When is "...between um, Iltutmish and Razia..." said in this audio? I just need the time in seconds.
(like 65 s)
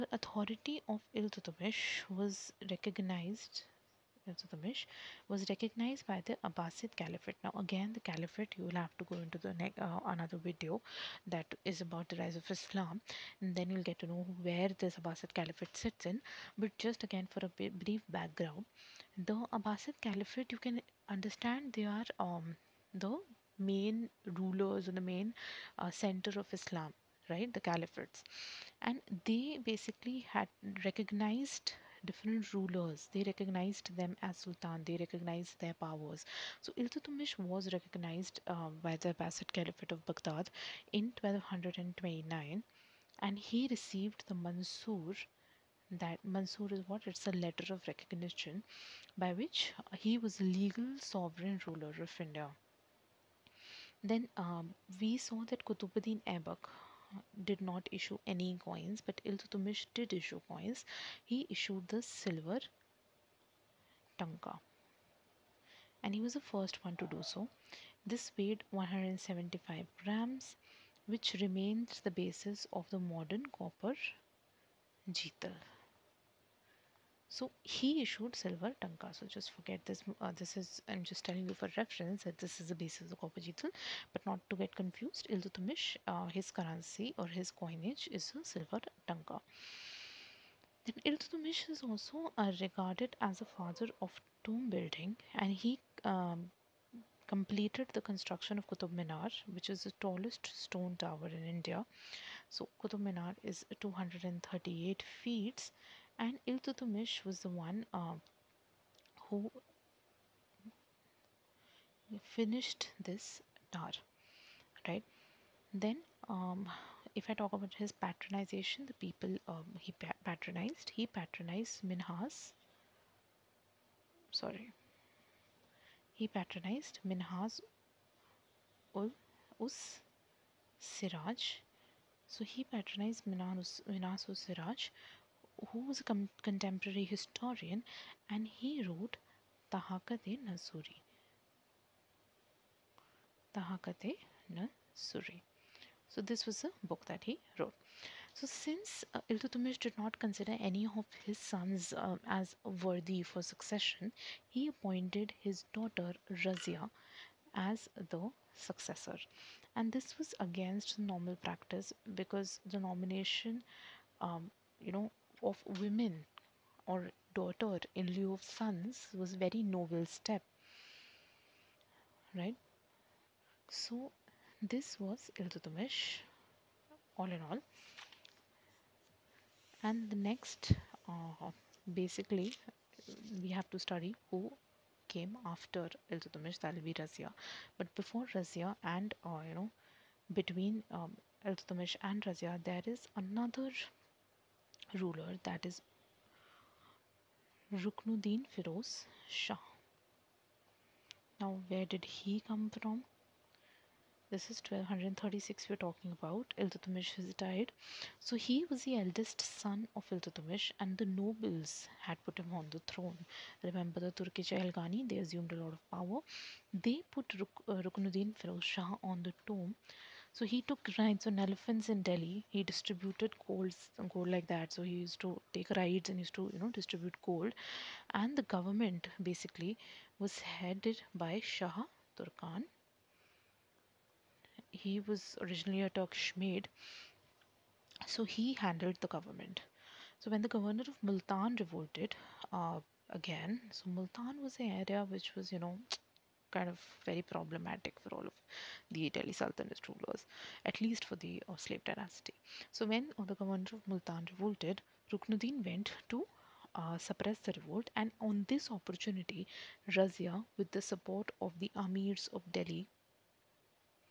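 190 s.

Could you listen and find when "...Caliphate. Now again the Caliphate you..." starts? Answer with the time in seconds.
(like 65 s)
6 s.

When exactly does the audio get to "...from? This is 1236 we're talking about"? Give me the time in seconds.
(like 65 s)
202 s.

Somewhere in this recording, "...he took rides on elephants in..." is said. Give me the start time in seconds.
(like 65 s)
220 s.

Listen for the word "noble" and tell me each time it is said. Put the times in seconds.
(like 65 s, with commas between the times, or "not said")
169 s, 211 s.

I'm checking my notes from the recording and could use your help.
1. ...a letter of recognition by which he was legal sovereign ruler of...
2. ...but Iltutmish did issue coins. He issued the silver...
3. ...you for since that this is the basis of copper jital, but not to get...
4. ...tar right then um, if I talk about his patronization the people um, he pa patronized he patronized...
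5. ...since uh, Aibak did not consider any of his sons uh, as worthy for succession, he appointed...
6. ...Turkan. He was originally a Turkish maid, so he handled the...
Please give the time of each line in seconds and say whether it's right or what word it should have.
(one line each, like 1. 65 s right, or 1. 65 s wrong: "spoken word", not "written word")
1. 47 s right
2. 59 s right
3. 81 s wrong: "reference", not "since"
4. 113 s right
5. 148 s wrong: "Iltutmish", not "Aibak"
6. 232 s right.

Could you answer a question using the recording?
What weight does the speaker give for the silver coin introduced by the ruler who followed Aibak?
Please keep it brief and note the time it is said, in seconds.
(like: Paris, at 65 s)
175 grams, at 68 s.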